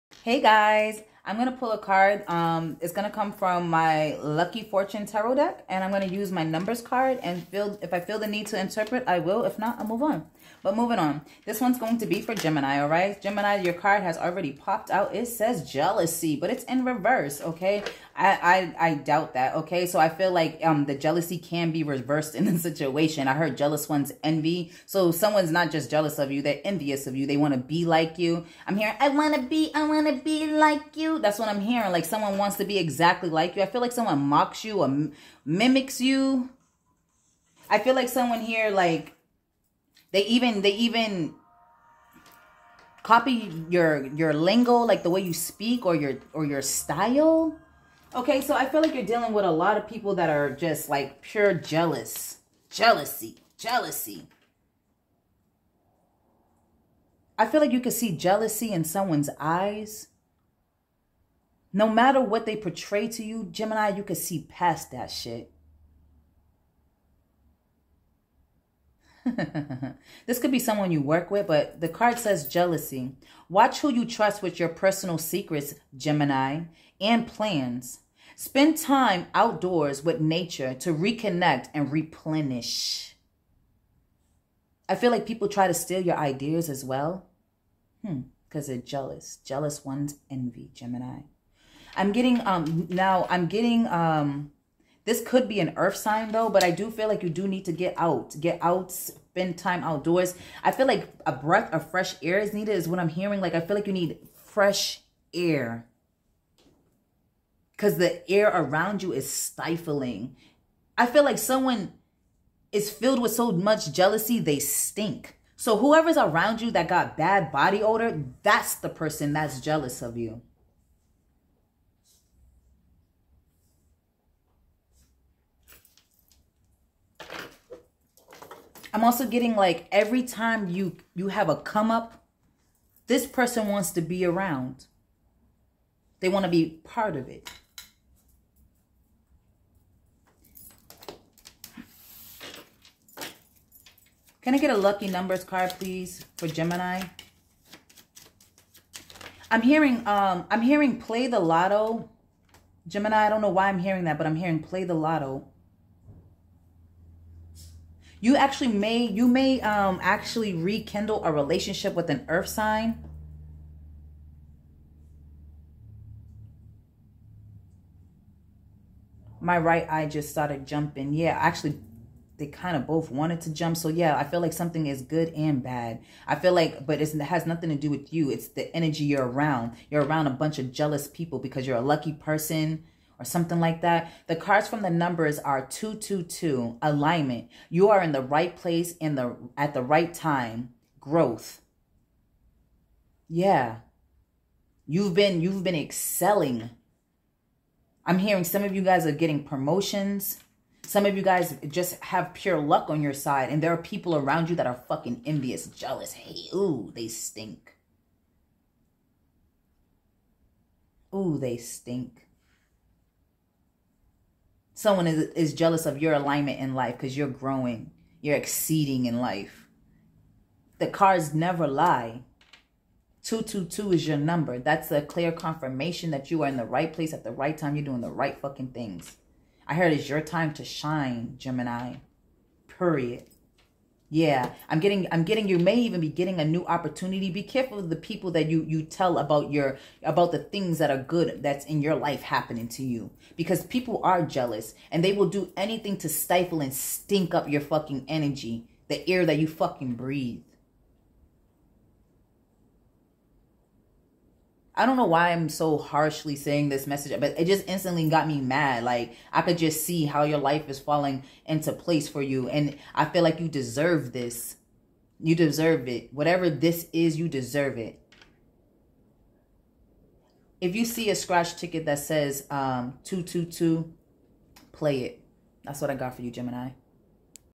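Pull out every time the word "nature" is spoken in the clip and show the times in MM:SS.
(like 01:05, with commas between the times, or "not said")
01:20.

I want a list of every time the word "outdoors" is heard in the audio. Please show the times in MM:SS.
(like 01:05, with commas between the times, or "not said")
01:19, 01:39.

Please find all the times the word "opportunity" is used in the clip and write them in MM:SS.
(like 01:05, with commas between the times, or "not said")
03:56.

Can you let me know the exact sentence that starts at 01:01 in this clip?
No matter what they portray to you, Gemini, you can see past that shit.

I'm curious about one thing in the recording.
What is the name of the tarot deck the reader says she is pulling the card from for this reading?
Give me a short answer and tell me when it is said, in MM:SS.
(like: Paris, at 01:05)
Lucky Fortune Tarot, at 00:04.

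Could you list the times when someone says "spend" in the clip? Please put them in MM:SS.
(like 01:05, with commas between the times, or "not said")
01:18, 01:38.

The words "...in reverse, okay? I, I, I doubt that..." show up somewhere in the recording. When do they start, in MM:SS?
00:16.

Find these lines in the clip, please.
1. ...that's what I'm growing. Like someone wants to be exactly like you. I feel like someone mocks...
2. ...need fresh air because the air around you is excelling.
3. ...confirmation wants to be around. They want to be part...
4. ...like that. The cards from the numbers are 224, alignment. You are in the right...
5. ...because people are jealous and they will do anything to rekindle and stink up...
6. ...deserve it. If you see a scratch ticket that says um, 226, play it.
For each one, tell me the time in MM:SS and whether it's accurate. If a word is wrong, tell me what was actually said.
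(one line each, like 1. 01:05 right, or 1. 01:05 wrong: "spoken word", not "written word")
1. 00:31 wrong: "hearing", not "growing"
2. 01:43 wrong: "stifling", not "excelling"
3. 02:13 wrong: "person", not "confirmation"
4. 03:03 wrong: "222", not "224"
5. 04:03 wrong: "stifle", not "rekindle"
6. 04:27 wrong: "222", not "226".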